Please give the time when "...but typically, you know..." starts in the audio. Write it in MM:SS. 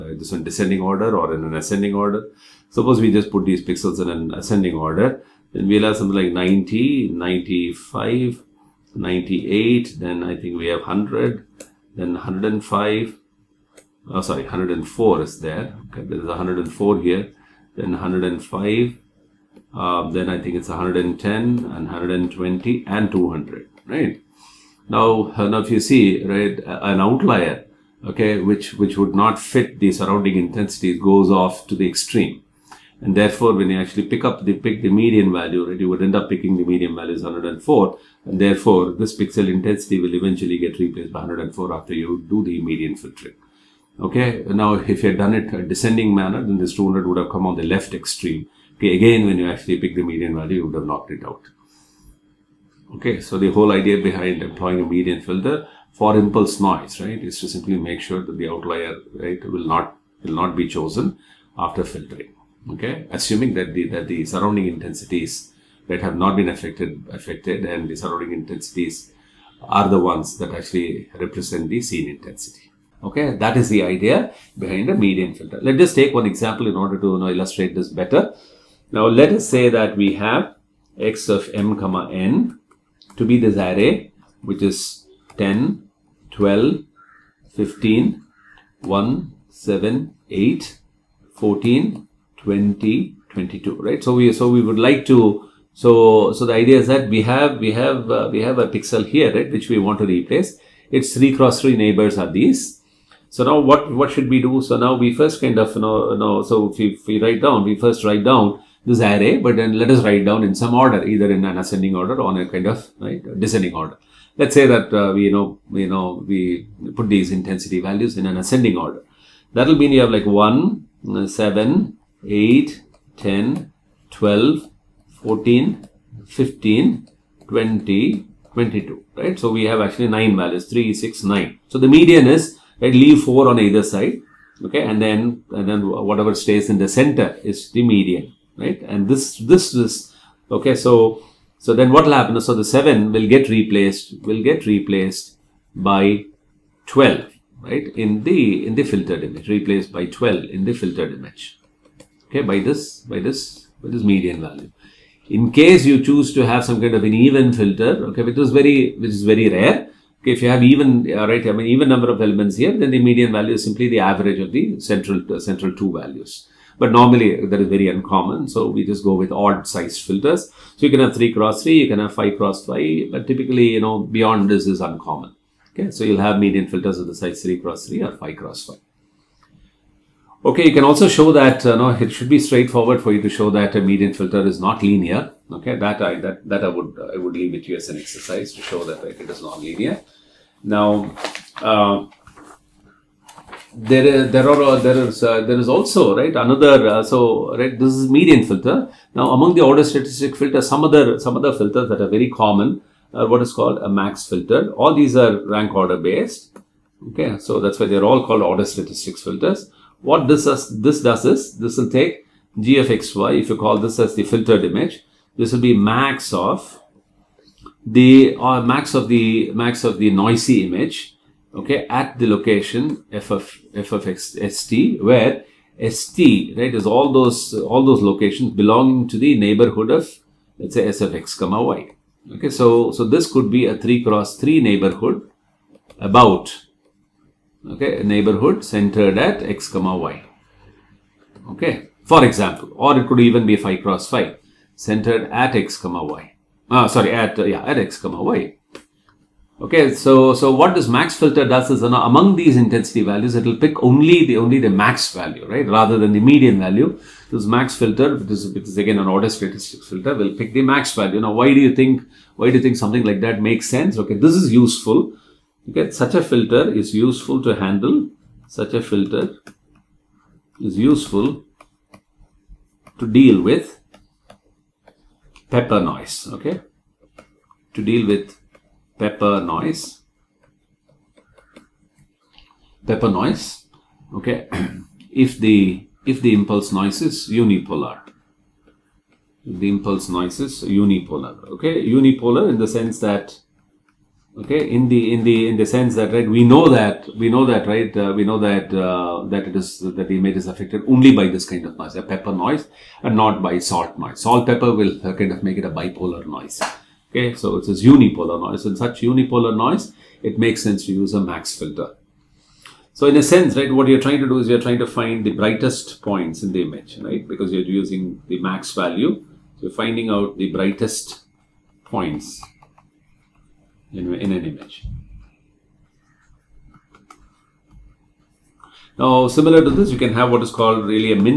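02:53.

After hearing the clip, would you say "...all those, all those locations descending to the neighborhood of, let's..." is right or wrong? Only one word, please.
wrong.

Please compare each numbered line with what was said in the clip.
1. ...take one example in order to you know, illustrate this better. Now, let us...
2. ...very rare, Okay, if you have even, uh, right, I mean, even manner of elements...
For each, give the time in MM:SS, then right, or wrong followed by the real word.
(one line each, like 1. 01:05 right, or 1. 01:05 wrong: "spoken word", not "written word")
1. 01:15 right
2. 02:39 wrong: "number", not "manner".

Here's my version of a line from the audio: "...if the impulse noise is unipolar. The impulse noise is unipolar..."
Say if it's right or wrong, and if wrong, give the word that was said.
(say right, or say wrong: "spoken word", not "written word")
right.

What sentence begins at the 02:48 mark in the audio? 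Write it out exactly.
So we just go with odd sized filters.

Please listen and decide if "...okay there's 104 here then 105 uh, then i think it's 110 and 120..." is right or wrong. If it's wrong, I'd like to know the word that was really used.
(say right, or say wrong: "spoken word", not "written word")
right.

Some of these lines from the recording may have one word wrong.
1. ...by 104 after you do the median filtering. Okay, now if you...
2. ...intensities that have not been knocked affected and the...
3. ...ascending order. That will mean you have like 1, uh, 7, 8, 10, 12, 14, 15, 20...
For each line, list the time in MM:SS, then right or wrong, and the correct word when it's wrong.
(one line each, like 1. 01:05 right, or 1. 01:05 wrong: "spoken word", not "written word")
1. 00:41 right
2. 01:04 wrong: "affected", not "knocked"
3. 01:58 right.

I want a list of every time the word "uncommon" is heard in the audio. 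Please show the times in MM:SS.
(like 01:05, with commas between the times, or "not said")
02:47, 02:54.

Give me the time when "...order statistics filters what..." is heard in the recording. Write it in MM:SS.
03:28.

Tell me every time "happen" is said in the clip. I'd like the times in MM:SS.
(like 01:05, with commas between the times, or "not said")
02:22.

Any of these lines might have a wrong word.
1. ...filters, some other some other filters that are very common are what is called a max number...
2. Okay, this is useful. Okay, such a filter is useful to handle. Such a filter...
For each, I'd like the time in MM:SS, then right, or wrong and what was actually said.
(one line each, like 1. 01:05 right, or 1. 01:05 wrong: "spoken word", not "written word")
1. 03:20 wrong: "filter", not "number"
2. 04:23 right.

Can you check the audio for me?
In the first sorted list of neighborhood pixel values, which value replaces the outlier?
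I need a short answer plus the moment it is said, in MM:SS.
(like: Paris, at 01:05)
104, at 00:36.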